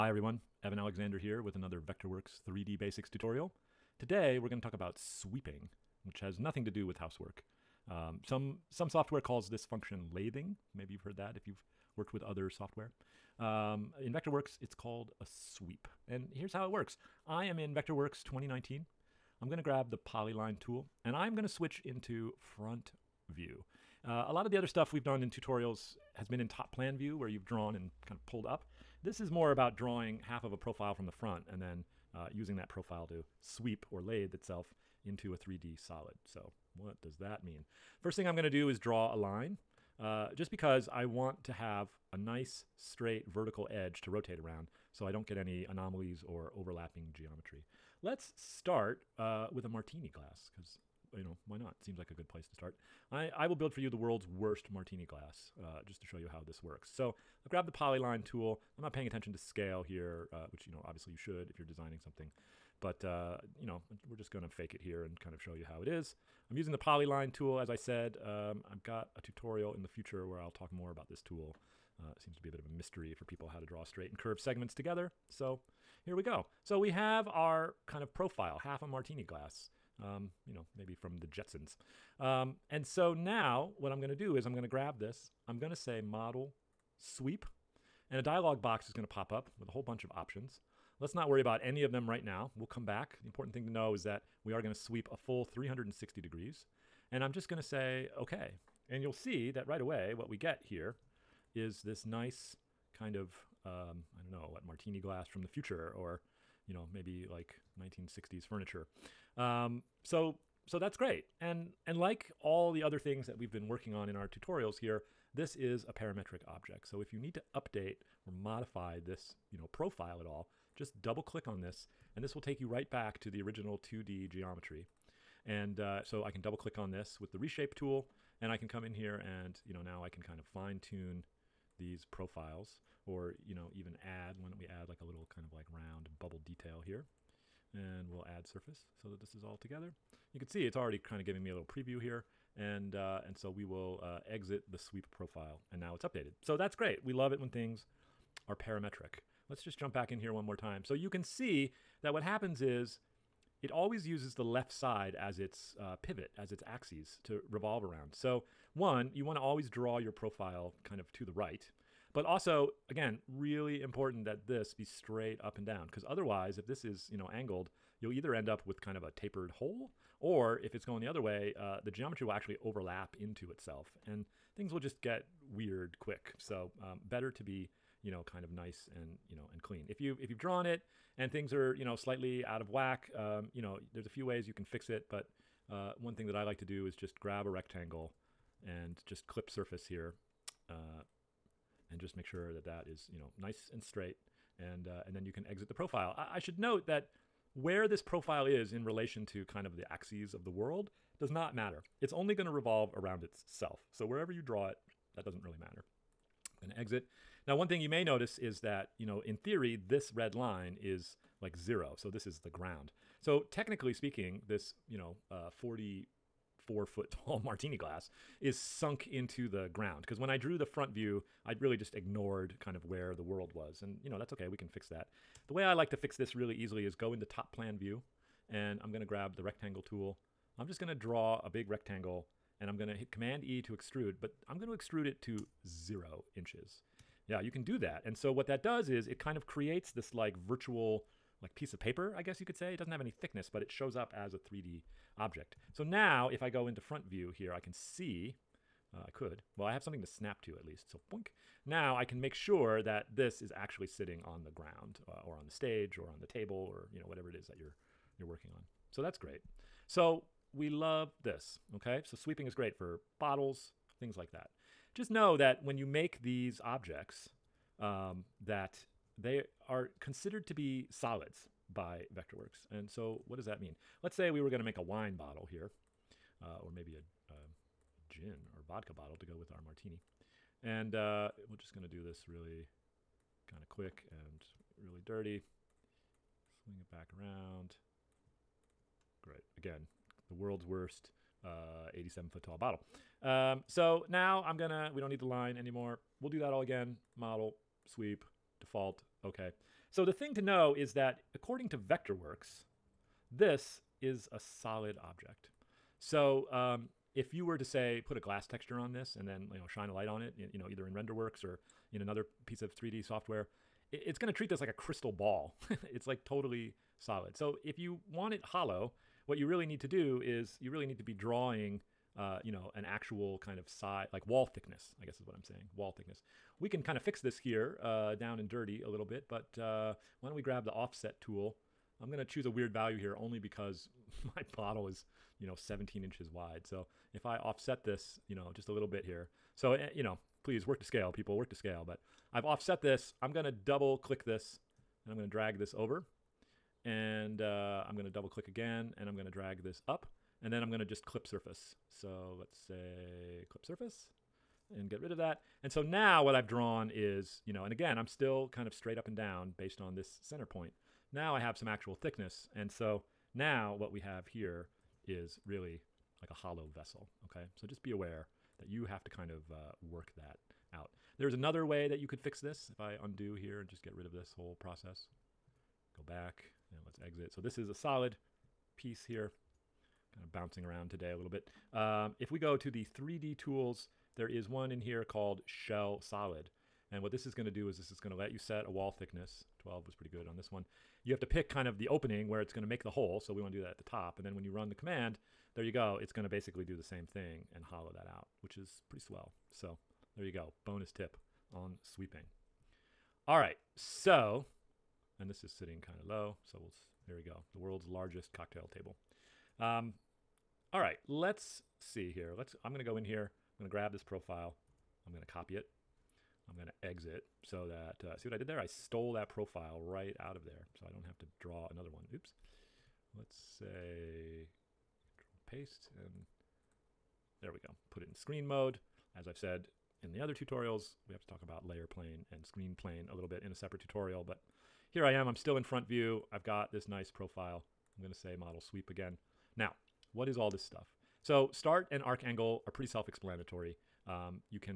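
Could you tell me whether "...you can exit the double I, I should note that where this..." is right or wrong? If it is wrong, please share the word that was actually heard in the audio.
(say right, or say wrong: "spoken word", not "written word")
wrong: "profile", not "double".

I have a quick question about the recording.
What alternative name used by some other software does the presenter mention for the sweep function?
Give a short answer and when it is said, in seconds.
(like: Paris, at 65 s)
lathing, at 10 s.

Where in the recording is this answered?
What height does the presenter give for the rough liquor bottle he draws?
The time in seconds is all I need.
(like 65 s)
291 s.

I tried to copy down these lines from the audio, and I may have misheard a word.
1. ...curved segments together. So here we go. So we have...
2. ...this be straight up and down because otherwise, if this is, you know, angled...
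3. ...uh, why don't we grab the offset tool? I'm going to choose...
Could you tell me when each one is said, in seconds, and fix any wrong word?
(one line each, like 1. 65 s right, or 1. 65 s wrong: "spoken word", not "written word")
1. 74 s right
2. 164 s right
3. 329 s right.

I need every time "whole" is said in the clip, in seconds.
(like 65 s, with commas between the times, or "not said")
89 s, 374 s.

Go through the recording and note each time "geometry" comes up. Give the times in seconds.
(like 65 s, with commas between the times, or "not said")
47 s, 124 s, 171 s.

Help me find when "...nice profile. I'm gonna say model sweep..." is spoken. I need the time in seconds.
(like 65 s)
436 s.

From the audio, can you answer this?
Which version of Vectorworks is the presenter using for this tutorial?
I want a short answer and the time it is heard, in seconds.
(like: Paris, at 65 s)
Vectorworks 2019, at 17 s.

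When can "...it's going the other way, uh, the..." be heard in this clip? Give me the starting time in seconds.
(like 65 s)
170 s.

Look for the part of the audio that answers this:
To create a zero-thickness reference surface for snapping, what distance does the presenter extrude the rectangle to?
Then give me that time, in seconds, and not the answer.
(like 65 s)
235 s.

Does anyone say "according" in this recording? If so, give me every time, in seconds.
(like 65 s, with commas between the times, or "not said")
301 s.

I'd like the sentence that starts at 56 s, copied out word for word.
So I've grabbed the polyline tool.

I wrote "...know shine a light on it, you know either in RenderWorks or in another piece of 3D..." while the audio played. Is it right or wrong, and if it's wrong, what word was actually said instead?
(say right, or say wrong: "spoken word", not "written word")
right.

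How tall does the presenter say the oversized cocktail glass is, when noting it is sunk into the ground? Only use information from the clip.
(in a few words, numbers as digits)
44 foot.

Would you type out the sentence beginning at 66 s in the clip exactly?
I'm using the polyline tool, as I said.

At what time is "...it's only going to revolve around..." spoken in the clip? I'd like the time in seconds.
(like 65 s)
202 s.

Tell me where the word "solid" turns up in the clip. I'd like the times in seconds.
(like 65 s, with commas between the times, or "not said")
35 s, 270 s, 304 s, 316 s, 377 s, 385 s.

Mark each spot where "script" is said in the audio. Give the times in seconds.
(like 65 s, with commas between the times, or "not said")
not said.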